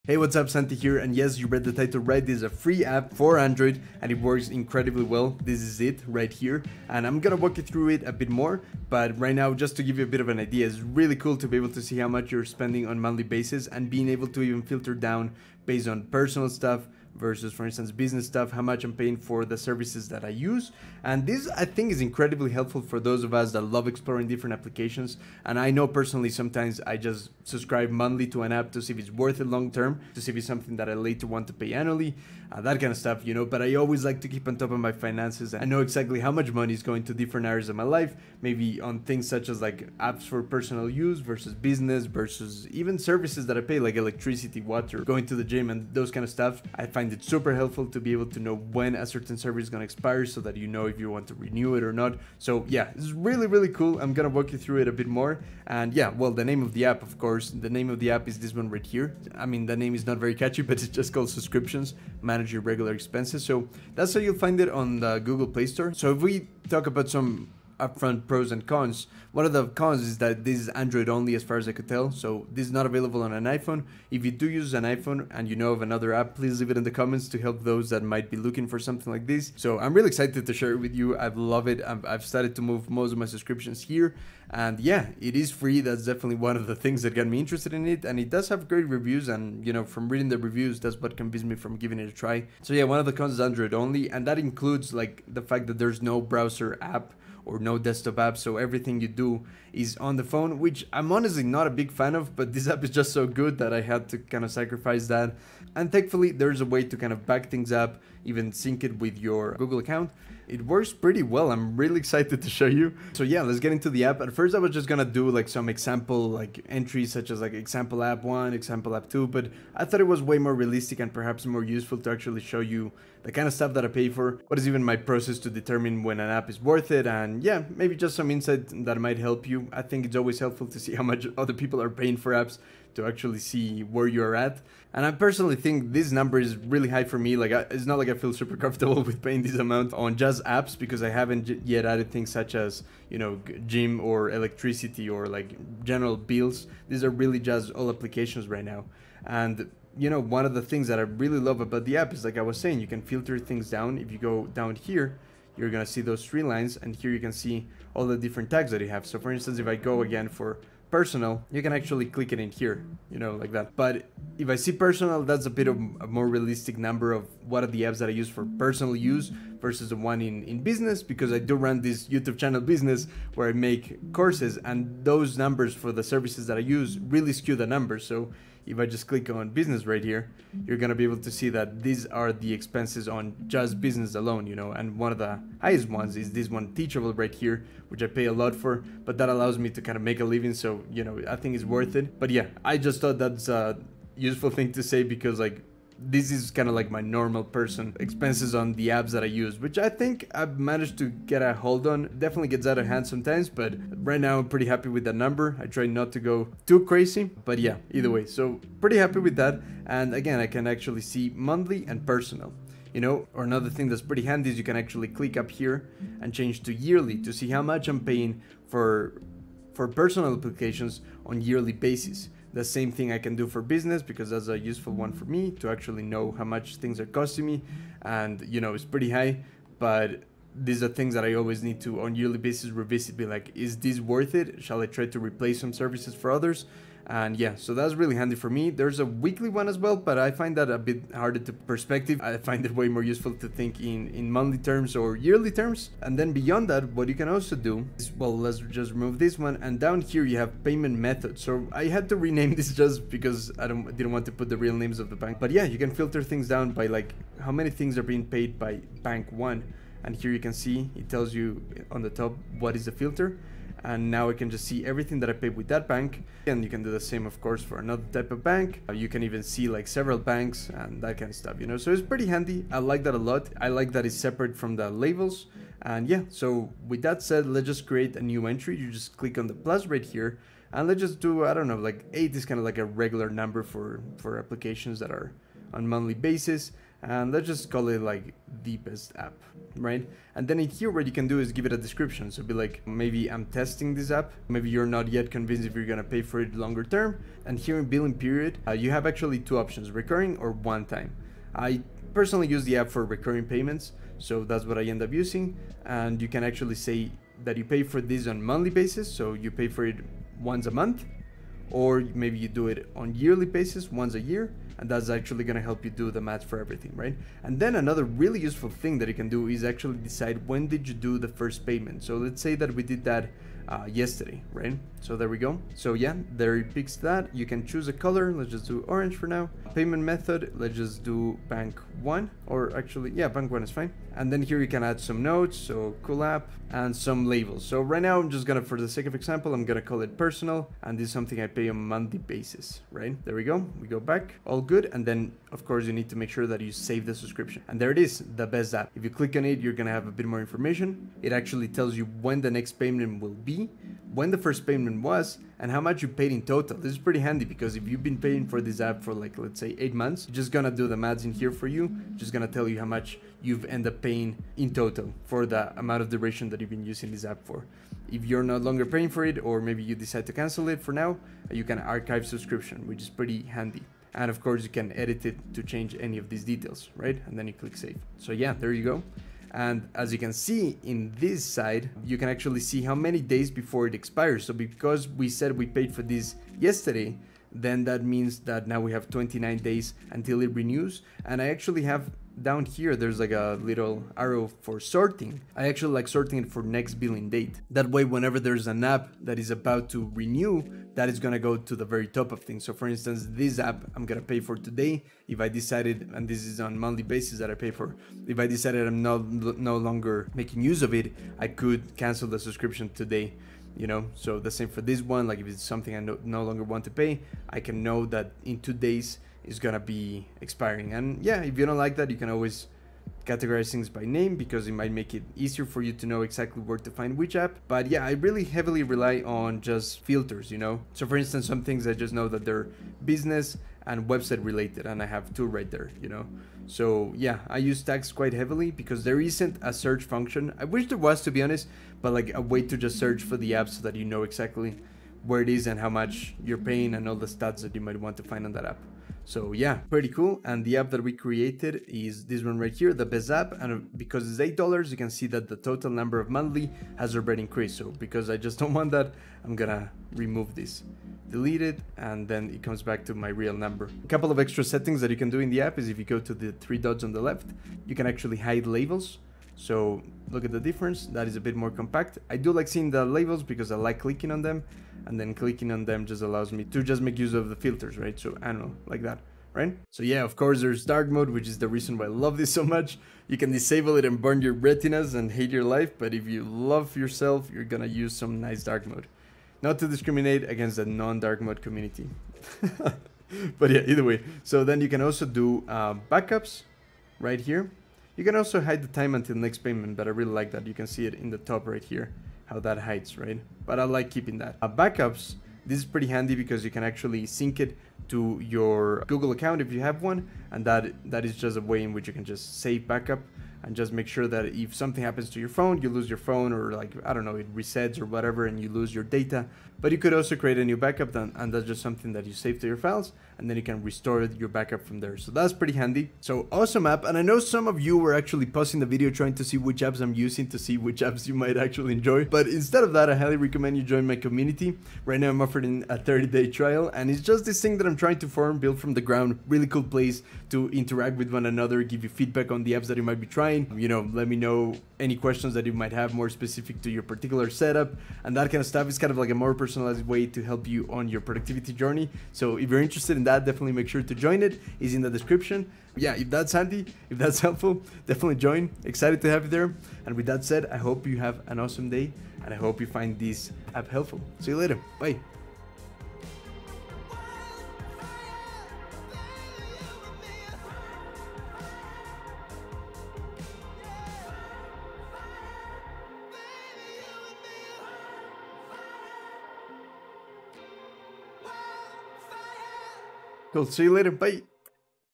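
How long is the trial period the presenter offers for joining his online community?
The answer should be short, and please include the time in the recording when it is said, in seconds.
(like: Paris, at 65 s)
30 days, at 535 s.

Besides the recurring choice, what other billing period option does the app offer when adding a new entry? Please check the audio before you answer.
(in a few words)
one time.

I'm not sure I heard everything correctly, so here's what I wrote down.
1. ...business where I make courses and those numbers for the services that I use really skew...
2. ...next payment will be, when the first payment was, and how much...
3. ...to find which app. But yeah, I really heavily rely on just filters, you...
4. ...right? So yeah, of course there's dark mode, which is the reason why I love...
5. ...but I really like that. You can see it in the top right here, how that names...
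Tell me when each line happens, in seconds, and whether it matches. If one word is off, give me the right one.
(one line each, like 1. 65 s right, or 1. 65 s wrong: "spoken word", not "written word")
1. 172 s right
2. 352 s right
3. 426 s right
4. 479 s right
5. 499 s wrong: "hides", not "names".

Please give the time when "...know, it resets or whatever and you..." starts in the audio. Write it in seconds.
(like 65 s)
517 s.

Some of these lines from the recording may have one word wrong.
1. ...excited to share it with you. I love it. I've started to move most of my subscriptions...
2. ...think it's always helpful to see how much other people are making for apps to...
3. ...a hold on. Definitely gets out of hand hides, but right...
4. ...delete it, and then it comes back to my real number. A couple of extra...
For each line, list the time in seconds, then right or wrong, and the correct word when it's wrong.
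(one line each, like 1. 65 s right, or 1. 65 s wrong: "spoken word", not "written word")
1. 80 s right
2. 129 s wrong: "paying", not "making"
3. 201 s wrong: "sometimes", not "hides"
4. 461 s right.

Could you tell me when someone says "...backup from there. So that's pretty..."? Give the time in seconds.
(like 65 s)
524 s.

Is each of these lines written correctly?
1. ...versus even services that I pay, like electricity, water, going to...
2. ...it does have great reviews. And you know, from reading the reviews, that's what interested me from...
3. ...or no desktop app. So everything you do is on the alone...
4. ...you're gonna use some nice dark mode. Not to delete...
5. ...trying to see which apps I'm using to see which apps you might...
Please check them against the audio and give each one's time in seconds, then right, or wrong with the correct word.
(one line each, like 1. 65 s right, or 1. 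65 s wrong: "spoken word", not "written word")
1. 42 s right
2. 88 s wrong: "convinced", not "interested"
3. 97 s wrong: "phone", not "alone"
4. 487 s wrong: "discriminate", not "delete"
5. 529 s right.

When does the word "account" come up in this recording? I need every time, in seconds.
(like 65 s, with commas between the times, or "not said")
109 s, 509 s.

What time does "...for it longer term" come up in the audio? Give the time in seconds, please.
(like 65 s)
296 s.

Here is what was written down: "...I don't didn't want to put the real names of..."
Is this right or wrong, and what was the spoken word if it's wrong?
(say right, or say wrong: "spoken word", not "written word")
right.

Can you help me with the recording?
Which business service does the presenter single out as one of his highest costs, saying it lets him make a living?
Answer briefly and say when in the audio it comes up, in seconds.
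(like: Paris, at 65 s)
Teachable, at 186 s.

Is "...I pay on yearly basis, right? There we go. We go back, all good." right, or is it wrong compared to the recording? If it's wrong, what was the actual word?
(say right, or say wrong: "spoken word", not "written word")
wrong: "monthly", not "yearly".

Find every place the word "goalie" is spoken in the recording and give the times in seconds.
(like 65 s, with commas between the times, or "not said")
not said.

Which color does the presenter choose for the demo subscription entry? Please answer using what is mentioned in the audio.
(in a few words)
orange.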